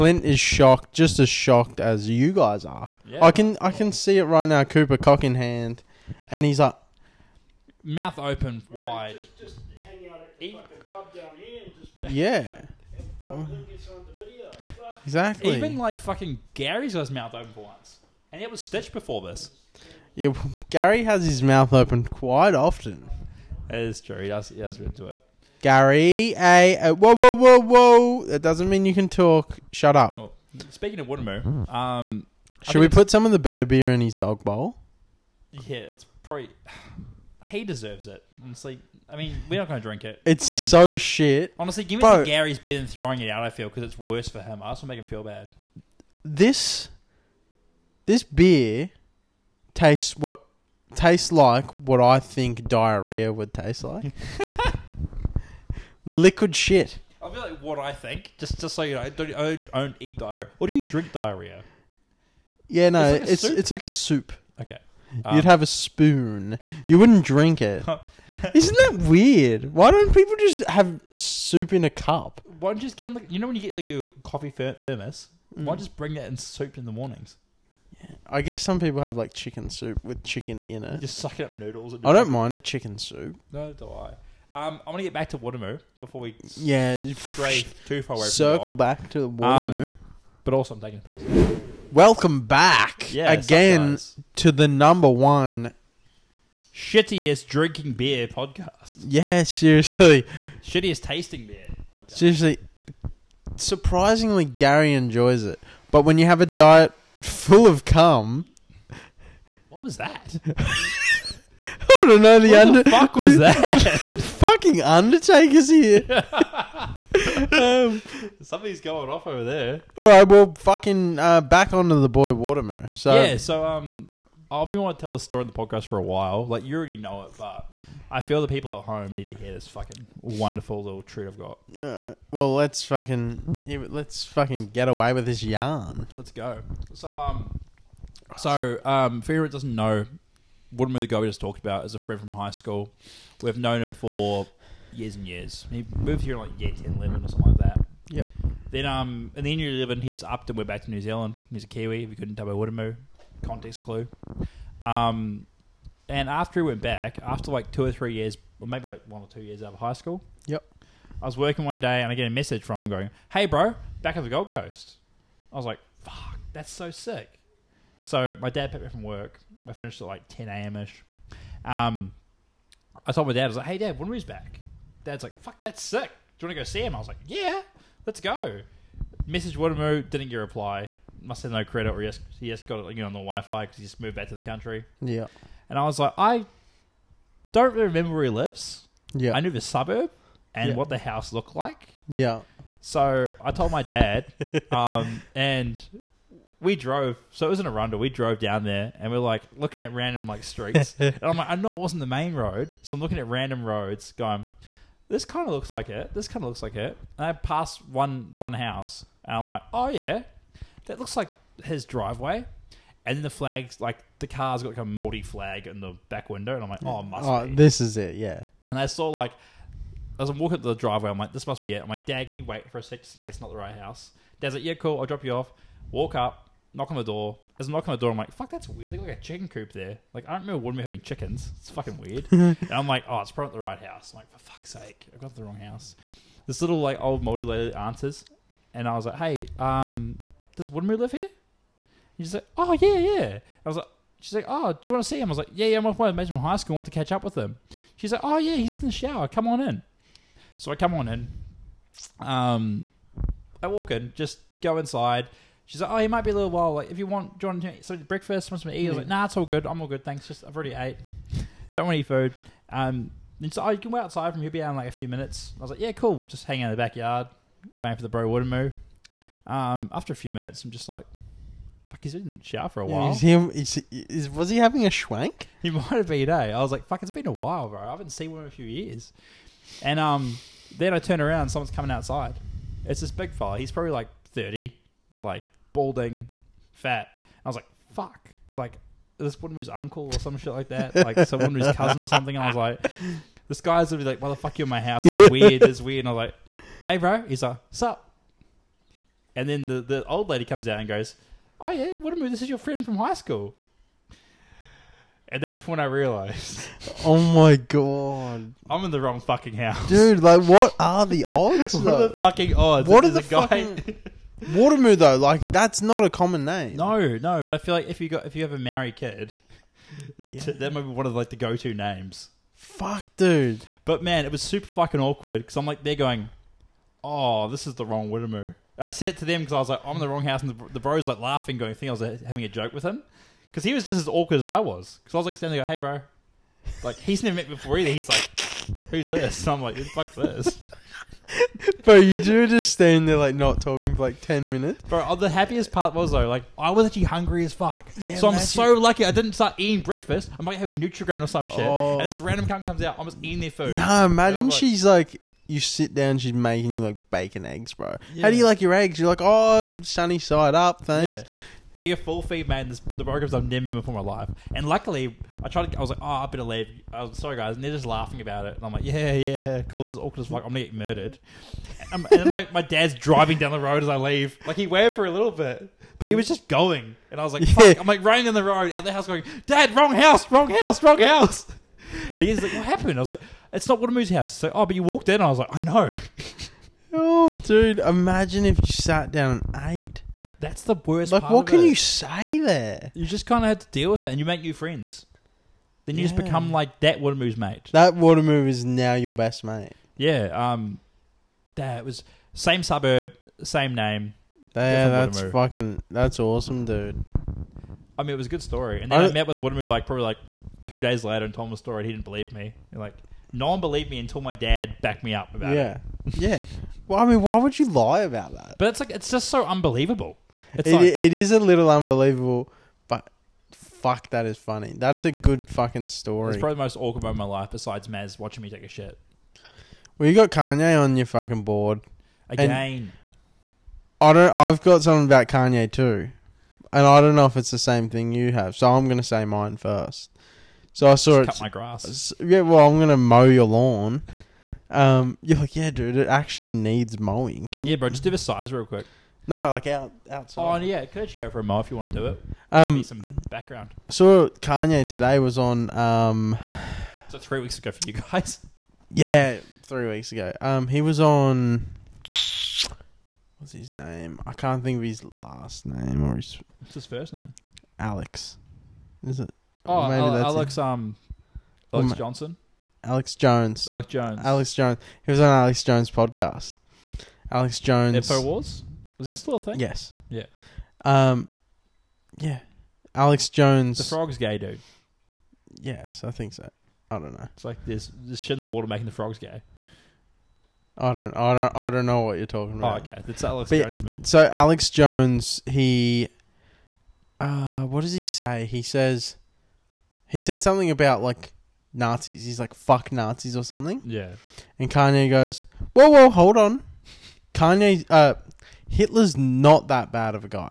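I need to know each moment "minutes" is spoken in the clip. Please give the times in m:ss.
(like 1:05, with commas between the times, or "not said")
4:25, 4:30, 5:44.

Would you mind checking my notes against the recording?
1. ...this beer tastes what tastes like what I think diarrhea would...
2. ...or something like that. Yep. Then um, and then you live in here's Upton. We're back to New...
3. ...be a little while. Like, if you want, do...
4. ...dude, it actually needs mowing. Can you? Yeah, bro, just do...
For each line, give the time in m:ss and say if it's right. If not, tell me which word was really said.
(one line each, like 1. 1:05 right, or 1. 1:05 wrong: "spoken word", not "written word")
1. 0:48 right
2. 2:27 right
3. 4:16 right
4. 7:25 right.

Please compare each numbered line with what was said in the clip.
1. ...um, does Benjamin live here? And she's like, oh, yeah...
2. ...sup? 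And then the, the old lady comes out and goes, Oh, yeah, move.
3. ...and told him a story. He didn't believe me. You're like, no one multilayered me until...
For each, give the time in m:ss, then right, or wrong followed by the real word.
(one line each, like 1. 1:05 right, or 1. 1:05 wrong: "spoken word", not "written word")
1. 3:59 wrong: "Windermere", not "Benjamin"
2. 4:57 right
3. 6:51 wrong: "believed", not "multilayered".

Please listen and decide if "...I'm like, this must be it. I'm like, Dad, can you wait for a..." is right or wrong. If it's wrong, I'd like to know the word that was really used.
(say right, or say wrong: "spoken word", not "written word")
right.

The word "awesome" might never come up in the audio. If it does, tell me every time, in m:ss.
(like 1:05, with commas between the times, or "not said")
6:46.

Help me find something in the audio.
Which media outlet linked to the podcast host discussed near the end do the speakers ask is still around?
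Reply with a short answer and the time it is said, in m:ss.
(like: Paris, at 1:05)
Infowars, at 7:57.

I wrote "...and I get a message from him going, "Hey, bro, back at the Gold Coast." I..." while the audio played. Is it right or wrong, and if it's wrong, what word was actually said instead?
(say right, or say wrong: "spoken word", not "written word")
right.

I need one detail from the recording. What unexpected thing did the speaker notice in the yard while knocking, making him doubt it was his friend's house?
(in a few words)
A chicken coop.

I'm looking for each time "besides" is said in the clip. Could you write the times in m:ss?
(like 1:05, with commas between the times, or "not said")
7:07.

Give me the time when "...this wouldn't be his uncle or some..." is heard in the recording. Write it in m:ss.
4:49.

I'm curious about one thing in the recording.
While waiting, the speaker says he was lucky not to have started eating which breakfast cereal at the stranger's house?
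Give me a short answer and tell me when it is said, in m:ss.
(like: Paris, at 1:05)
Nutrigrain, at 5:50.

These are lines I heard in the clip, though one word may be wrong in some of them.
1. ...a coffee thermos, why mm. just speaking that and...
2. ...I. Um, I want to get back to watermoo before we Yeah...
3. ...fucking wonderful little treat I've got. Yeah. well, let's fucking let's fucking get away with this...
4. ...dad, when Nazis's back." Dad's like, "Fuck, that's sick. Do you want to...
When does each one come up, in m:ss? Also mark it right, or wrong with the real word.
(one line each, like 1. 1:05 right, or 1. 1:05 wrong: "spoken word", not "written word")
1. 1:13 wrong: "bring", not "speaking"
2. 1:23 right
3. 2:09 right
4. 2:53 wrong: "Winry", not "Nazis".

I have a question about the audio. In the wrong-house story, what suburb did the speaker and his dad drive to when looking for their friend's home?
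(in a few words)
Arundel.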